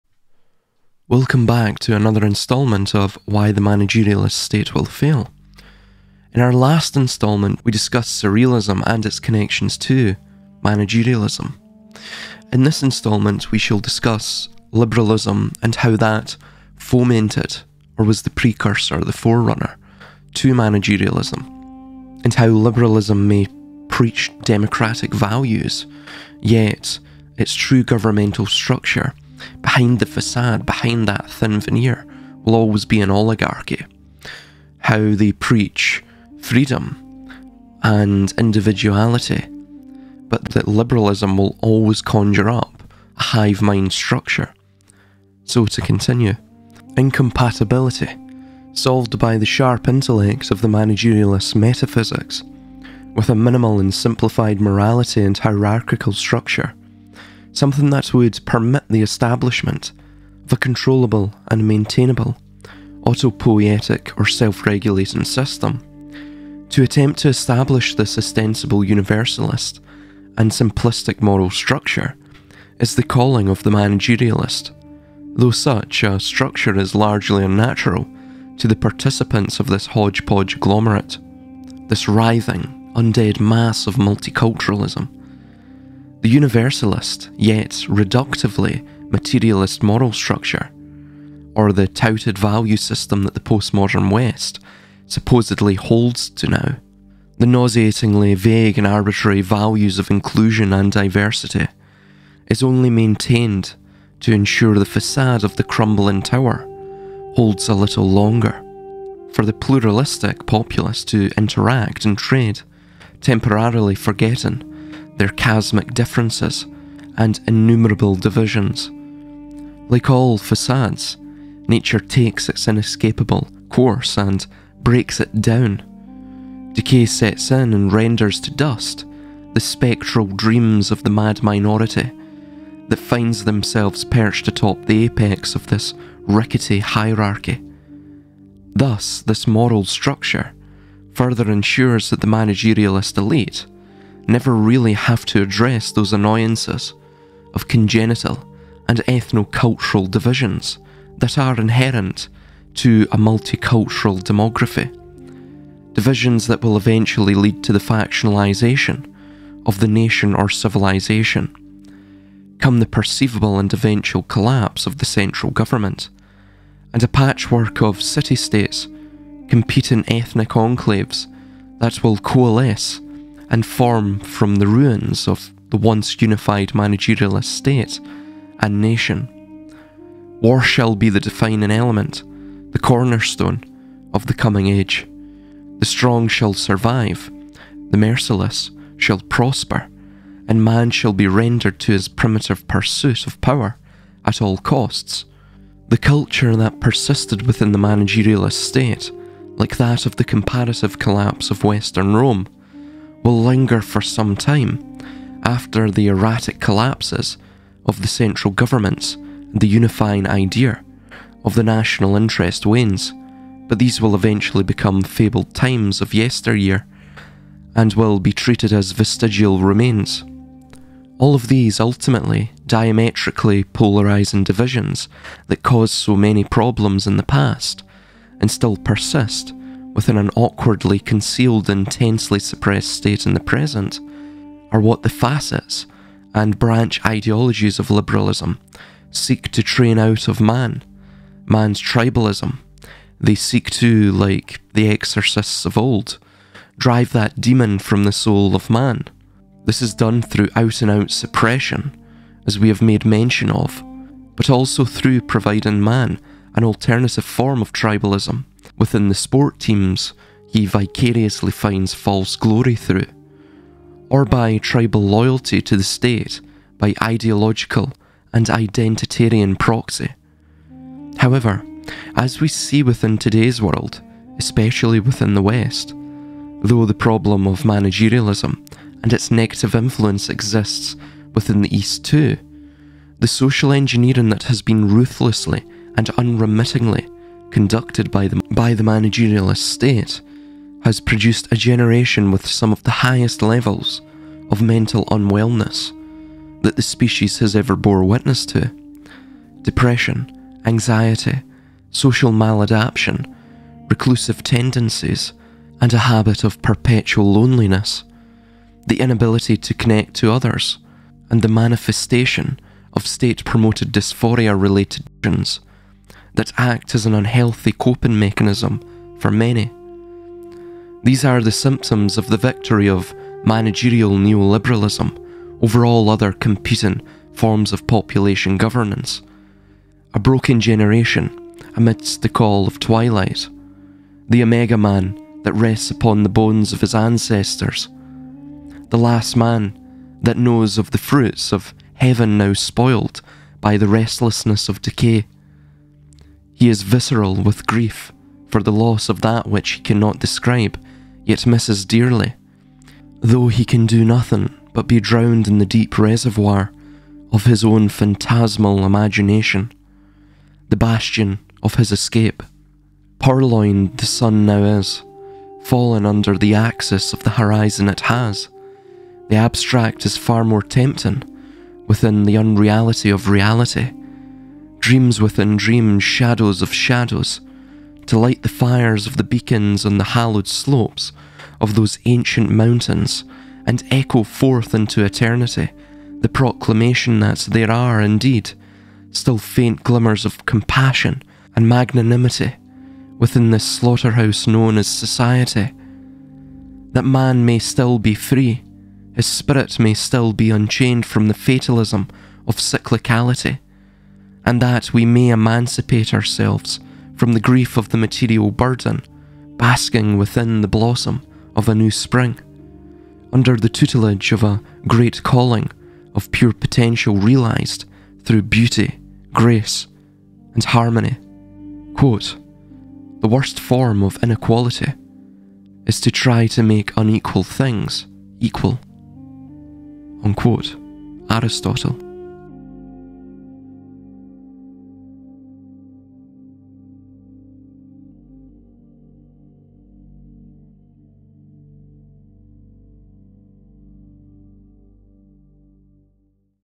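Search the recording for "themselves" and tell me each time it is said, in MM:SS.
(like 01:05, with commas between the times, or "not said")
02:13.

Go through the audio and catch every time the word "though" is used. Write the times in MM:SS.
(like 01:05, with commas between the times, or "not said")
01:15, 04:36, 05:53.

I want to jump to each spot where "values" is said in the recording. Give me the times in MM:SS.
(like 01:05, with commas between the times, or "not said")
00:25, 01:32, 01:39.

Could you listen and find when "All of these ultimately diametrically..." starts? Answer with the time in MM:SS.
03:41.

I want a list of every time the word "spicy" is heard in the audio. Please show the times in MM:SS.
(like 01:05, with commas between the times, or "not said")
not said.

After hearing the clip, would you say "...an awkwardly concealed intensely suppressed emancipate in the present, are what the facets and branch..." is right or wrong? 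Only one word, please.
wrong.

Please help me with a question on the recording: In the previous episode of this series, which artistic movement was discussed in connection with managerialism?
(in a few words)
Surrealism.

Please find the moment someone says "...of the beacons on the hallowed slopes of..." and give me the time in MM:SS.
06:19.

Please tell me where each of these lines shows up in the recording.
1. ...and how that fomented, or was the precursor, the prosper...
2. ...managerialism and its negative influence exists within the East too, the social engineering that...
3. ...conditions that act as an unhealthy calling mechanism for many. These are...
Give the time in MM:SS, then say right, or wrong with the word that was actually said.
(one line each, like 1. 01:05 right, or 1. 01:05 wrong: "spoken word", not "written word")
1. 00:15 wrong: "forerunner", not "prosper"
2. 04:37 right
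3. 05:15 wrong: "coping", not "calling".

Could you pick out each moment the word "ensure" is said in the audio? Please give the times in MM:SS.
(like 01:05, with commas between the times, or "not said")
01:44, 02:21.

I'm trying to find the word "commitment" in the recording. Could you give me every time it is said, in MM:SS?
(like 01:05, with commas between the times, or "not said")
not said.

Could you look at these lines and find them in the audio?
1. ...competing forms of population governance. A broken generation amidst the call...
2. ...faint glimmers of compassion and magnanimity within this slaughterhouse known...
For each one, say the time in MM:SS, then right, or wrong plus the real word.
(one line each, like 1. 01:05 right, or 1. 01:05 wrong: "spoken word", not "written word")
1. 05:26 right
2. 06:29 right.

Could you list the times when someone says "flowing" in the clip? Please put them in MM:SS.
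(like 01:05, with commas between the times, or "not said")
not said.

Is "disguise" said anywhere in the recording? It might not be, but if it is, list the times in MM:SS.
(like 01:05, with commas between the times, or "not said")
not said.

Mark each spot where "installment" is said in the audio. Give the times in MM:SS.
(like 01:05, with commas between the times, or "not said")
00:02, 00:06, 00:12.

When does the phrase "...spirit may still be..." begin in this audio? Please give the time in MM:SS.
06:39.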